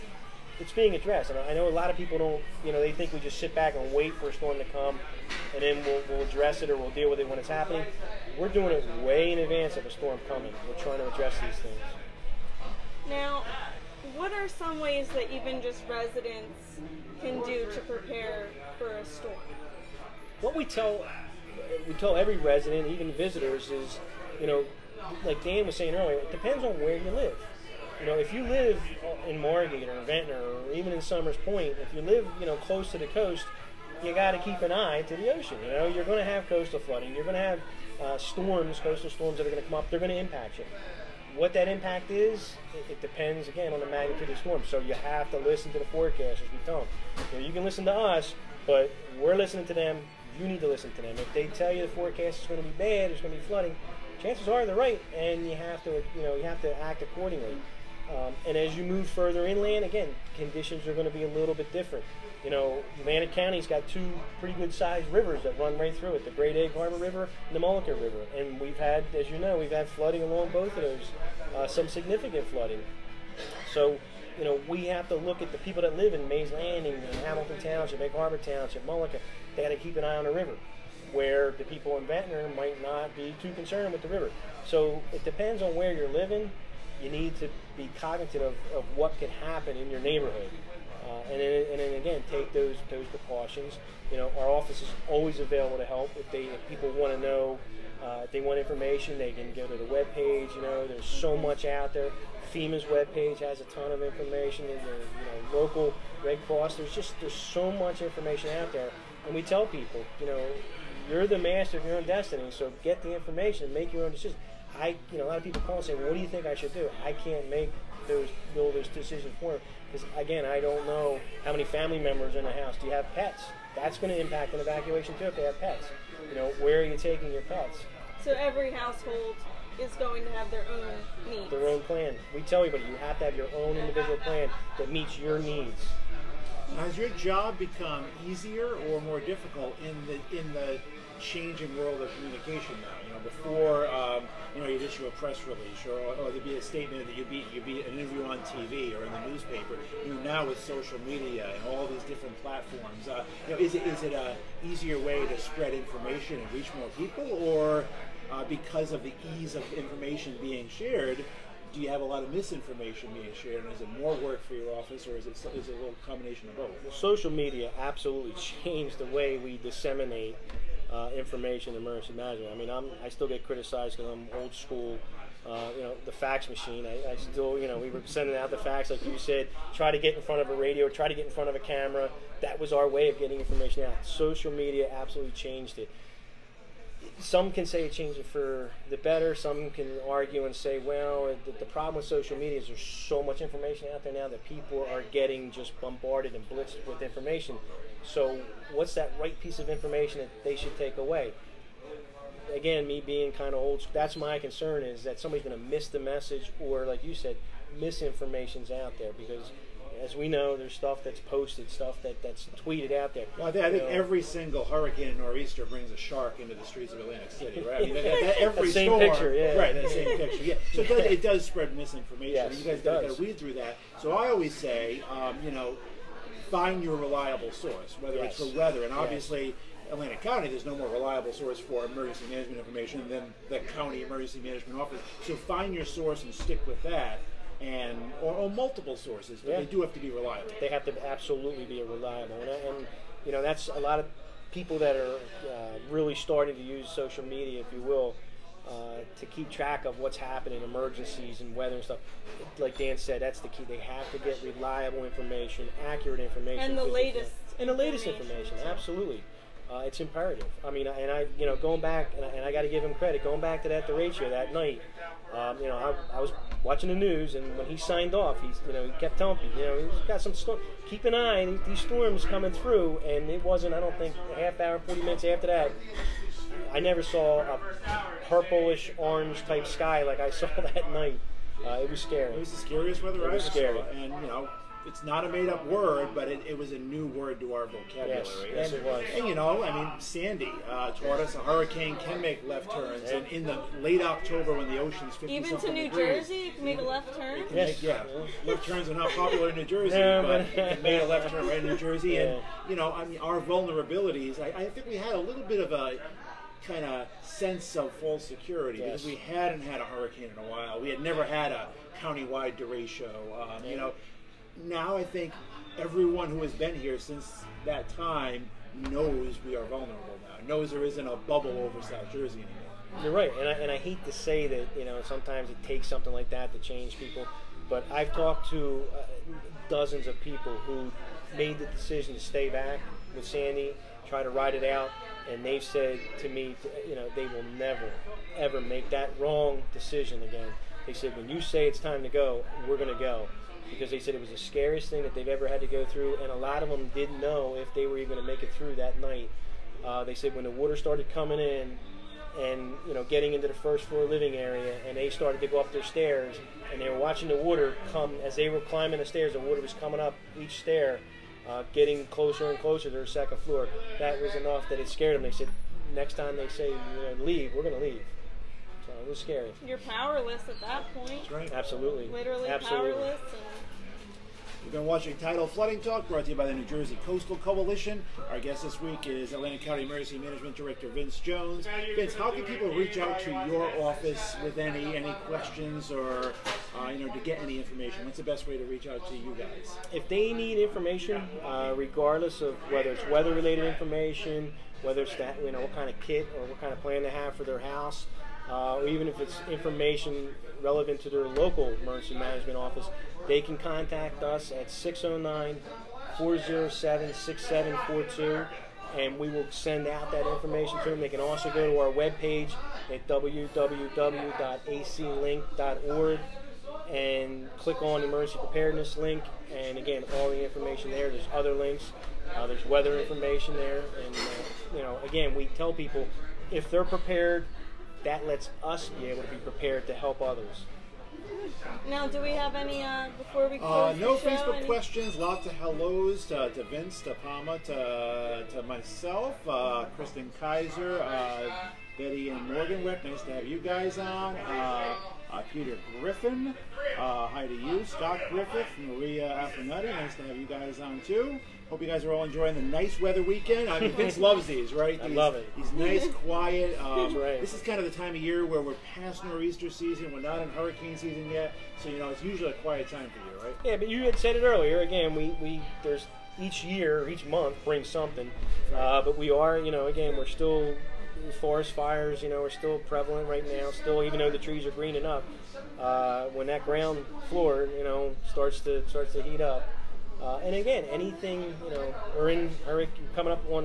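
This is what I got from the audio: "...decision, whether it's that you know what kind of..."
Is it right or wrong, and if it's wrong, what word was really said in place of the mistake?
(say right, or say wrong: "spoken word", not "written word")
wrong: "information", not "decision".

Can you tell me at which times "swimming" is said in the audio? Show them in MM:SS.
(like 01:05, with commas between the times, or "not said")
not said.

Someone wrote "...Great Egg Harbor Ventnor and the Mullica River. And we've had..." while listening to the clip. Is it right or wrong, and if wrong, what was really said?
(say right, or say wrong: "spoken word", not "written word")
wrong: "River", not "Ventnor".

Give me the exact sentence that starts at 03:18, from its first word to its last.
So what's that right piece of information that they should take away?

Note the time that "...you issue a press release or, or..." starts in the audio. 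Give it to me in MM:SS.
02:24.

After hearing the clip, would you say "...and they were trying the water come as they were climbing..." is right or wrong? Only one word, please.
wrong.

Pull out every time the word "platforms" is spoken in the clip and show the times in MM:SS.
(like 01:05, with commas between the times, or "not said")
02:32.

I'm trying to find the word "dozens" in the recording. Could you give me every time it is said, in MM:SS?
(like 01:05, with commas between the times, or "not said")
05:29.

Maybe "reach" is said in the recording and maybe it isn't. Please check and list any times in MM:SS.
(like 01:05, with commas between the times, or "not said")
02:36, 06:22, 06:28.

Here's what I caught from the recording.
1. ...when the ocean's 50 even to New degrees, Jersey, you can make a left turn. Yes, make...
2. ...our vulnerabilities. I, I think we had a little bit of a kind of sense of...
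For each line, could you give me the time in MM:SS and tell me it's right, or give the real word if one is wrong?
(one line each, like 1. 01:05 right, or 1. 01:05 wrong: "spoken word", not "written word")
1. 04:54 right
2. 05:03 right.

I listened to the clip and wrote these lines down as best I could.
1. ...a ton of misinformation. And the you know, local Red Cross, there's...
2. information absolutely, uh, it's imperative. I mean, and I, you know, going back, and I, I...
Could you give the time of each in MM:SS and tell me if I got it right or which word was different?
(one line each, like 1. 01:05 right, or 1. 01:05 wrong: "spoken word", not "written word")
1. 01:43 wrong: "information", not "misinformation"
2. 04:18 right.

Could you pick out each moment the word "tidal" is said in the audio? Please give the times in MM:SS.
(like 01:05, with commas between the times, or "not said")
06:15.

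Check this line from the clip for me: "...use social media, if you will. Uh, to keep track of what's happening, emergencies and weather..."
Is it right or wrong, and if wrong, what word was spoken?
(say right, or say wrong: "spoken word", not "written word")
right.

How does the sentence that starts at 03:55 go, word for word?
So find your source and stick with that.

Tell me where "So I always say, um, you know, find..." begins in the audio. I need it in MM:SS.
03:44.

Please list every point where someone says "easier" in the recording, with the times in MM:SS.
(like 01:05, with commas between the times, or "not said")
02:18, 02:34.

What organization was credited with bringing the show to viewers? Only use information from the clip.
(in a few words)
New Jersey Coastal Coalition.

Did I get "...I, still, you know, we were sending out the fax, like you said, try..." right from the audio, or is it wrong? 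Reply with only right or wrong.
right.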